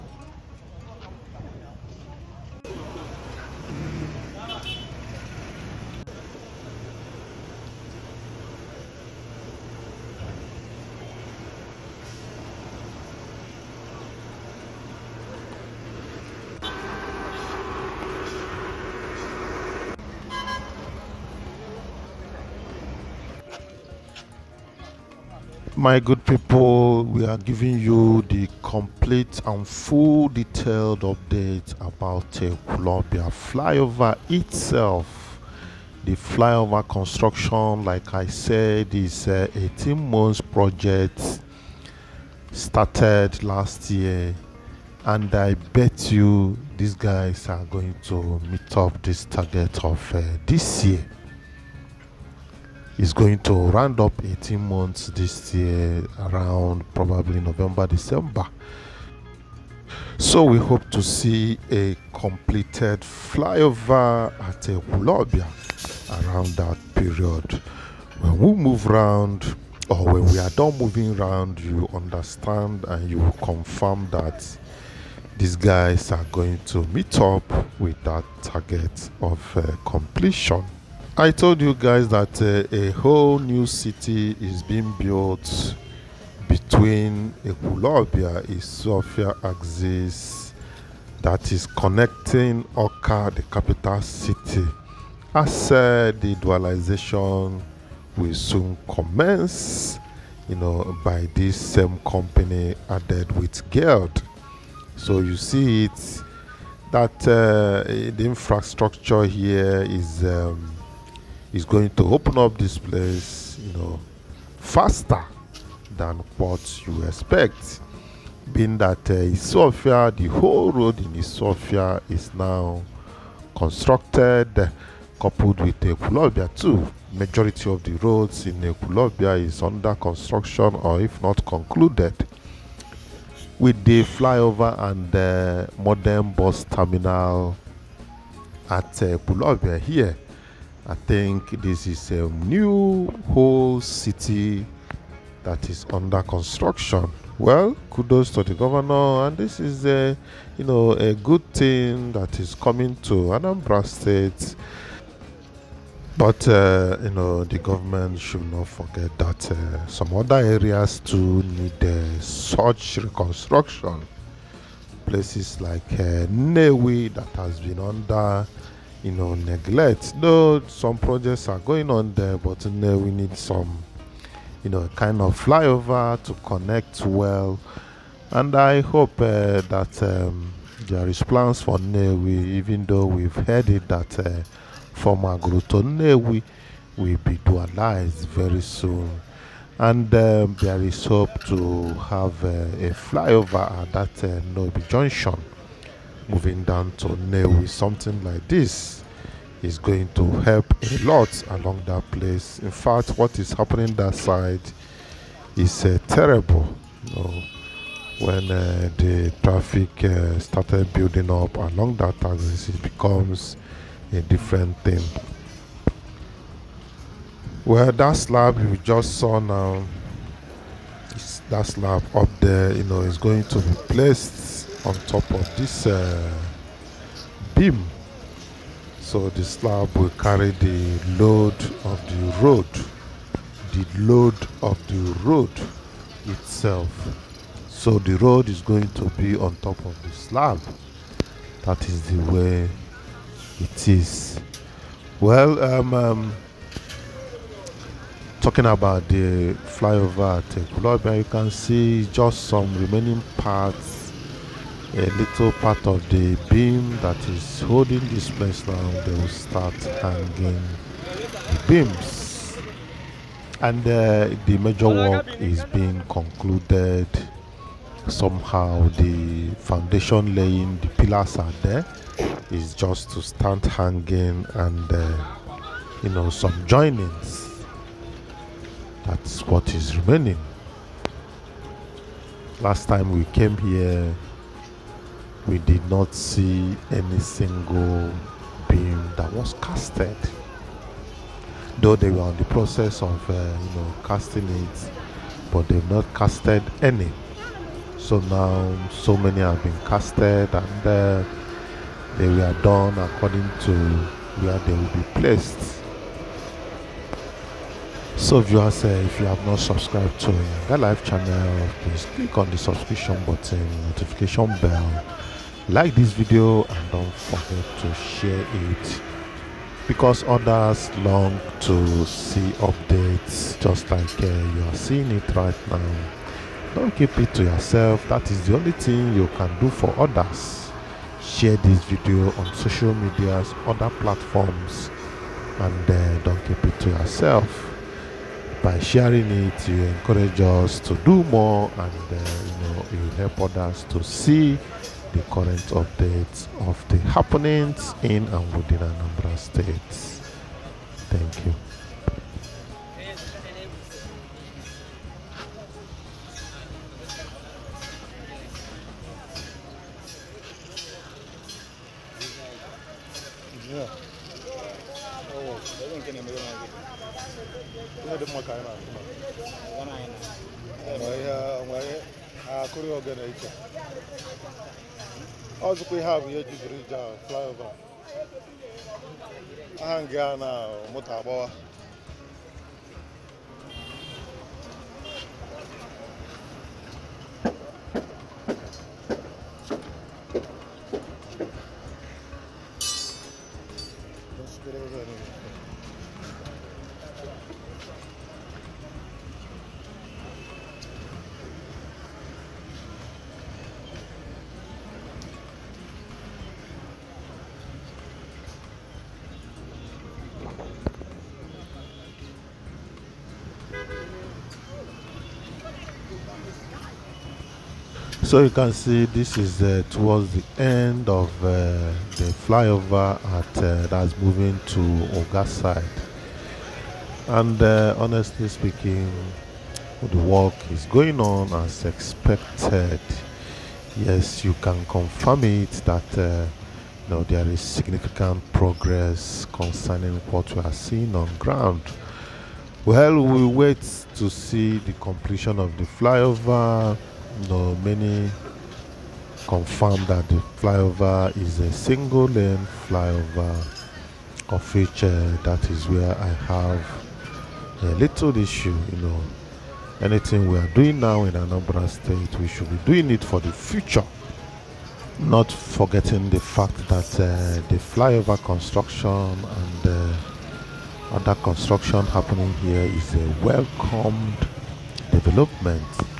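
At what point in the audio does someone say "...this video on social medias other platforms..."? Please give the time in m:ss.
5:31.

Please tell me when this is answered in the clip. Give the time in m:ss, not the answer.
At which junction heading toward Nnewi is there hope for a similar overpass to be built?
3:14.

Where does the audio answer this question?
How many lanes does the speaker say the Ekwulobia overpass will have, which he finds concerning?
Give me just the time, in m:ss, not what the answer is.
7:31.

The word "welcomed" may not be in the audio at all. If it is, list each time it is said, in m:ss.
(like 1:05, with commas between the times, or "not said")
7:53.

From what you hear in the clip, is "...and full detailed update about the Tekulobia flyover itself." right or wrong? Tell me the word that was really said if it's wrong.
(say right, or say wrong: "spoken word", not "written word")
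right.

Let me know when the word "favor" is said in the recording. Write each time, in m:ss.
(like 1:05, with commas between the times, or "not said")
not said.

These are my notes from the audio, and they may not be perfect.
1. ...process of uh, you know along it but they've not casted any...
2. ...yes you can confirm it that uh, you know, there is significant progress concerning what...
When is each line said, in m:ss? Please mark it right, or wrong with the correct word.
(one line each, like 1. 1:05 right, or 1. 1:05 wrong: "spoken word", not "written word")
1. 4:52 wrong: "casting", not "along"
2. 7:13 right.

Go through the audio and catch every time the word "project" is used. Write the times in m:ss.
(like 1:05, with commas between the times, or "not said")
0:40, 2:50.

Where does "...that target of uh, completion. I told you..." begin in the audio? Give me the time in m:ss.
1:18.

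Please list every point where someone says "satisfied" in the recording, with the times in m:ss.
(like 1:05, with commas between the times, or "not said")
not said.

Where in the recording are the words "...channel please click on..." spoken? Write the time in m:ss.
5:11.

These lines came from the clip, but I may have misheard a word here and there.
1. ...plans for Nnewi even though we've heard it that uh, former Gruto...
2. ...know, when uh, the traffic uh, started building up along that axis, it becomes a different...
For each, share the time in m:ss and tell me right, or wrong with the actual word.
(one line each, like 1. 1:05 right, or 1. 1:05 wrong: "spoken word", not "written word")
1. 3:01 right
2. 3:27 right.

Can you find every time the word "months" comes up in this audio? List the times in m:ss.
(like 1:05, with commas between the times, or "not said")
0:40, 0:54.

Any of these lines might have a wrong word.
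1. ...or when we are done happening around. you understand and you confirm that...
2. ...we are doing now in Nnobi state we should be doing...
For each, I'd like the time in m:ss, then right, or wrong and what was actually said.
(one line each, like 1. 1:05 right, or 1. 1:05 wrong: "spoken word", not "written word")
1. 1:09 wrong: "moving", not "happening"
2. 7:40 wrong: "Anambra", not "Nnobi".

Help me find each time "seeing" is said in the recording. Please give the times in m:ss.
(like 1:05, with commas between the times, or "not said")
5:24, 7:20.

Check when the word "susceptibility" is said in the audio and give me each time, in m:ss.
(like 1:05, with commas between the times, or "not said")
not said.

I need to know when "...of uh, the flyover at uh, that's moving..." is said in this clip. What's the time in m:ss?
7:01.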